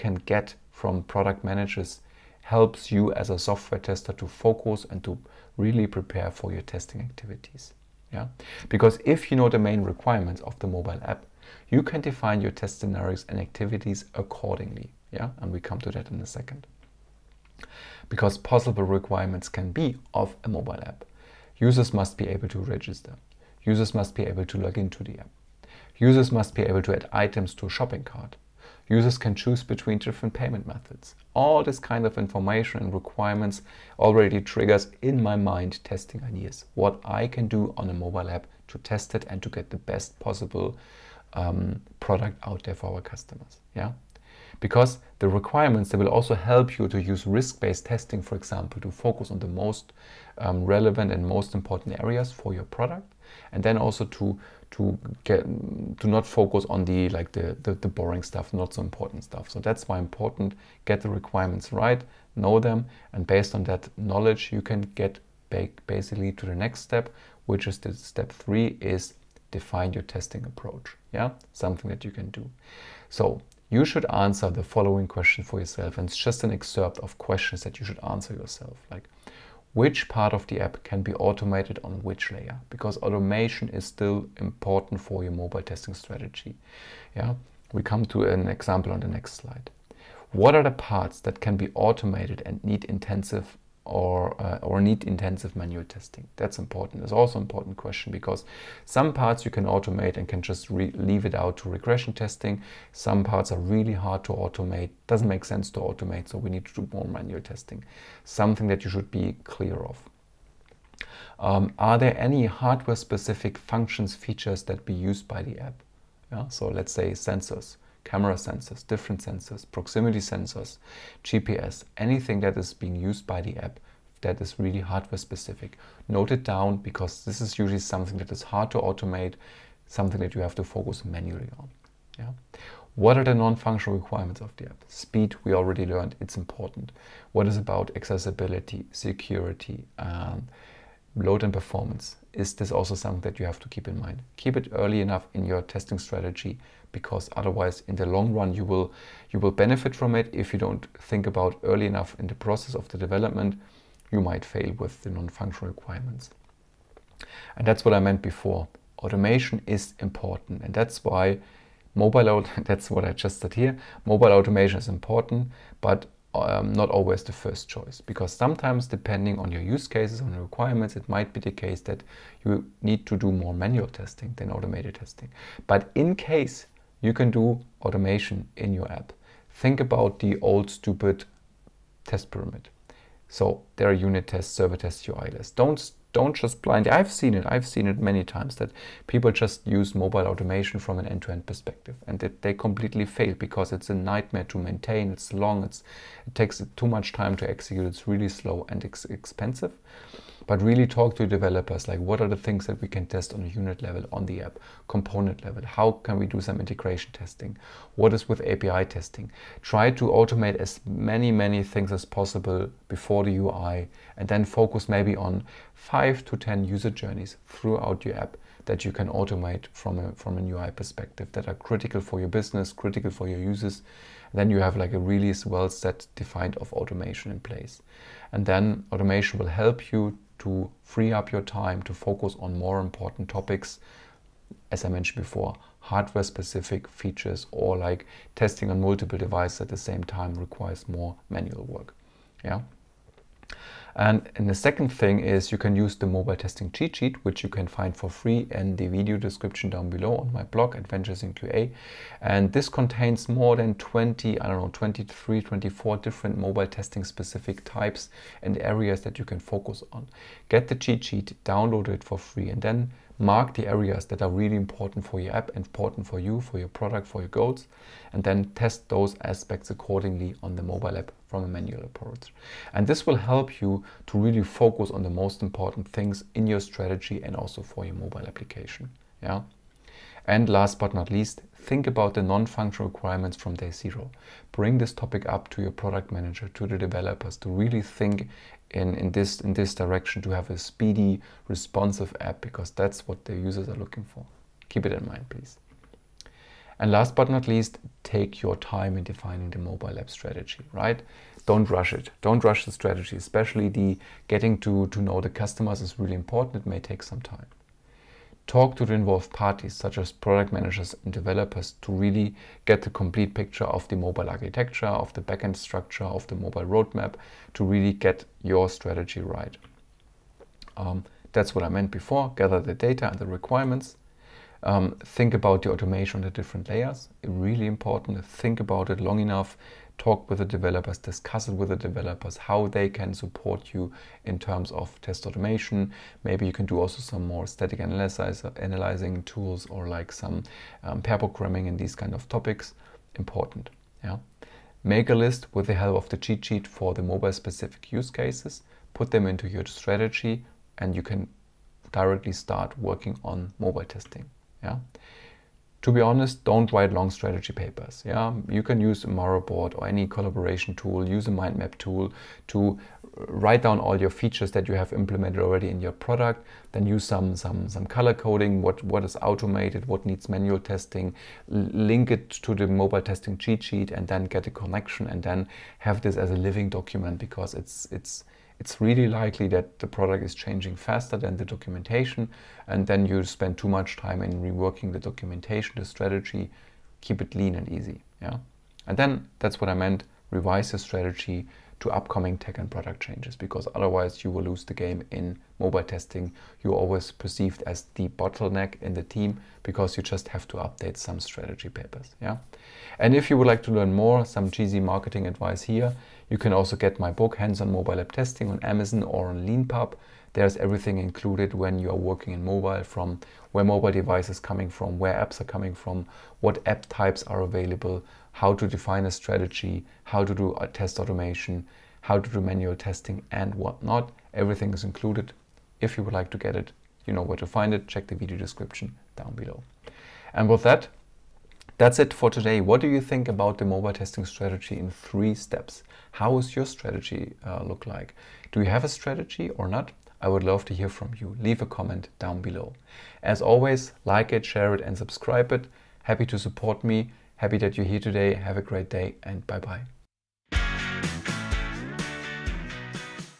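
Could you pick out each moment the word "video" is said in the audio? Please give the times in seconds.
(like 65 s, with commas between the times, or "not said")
248 s, 428 s.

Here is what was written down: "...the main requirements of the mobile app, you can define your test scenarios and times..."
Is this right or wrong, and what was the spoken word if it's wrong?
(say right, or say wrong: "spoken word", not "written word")
wrong: "activities", not "times".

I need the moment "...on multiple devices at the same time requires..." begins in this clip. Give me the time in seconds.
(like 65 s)
238 s.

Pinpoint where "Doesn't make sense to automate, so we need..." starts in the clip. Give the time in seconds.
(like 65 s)
105 s.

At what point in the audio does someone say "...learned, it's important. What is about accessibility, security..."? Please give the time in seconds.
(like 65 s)
135 s.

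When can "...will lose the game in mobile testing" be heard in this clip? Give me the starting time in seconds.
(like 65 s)
394 s.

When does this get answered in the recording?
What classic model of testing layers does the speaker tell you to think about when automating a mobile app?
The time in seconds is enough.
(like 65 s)
182 s.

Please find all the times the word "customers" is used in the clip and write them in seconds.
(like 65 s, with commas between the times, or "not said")
43 s, 305 s.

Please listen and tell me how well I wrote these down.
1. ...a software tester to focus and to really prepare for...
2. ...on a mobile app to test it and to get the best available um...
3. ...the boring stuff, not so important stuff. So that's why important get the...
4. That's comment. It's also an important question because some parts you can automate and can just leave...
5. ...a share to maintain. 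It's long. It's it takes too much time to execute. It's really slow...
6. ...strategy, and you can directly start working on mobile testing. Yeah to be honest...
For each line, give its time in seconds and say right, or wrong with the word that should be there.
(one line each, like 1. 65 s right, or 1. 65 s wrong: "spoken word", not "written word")
1. 3 s right
2. 37 s wrong: "possible", not "available"
3. 57 s right
4. 96 s wrong: "important", not "comment"
5. 193 s wrong: "nightmare", not "share"
6. 349 s right.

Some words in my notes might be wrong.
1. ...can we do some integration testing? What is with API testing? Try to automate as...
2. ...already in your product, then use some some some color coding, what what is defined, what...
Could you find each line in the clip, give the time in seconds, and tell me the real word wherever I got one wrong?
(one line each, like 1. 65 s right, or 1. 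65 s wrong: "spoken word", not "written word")
1. 205 s right
2. 365 s wrong: "automated", not "defined".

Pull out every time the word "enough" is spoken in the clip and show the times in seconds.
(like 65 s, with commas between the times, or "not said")
144 s, 151 s, 329 s.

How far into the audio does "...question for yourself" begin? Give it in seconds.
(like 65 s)
75 s.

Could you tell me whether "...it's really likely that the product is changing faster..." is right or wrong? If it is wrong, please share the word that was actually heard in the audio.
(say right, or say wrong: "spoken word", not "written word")
right.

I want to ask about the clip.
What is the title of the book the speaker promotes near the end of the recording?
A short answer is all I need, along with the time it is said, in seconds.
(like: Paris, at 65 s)
Hands-on Mobile App Testing, at 407 s.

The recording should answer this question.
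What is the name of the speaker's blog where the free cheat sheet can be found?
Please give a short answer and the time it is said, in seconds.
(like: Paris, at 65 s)
Adventures in QA, at 250 s.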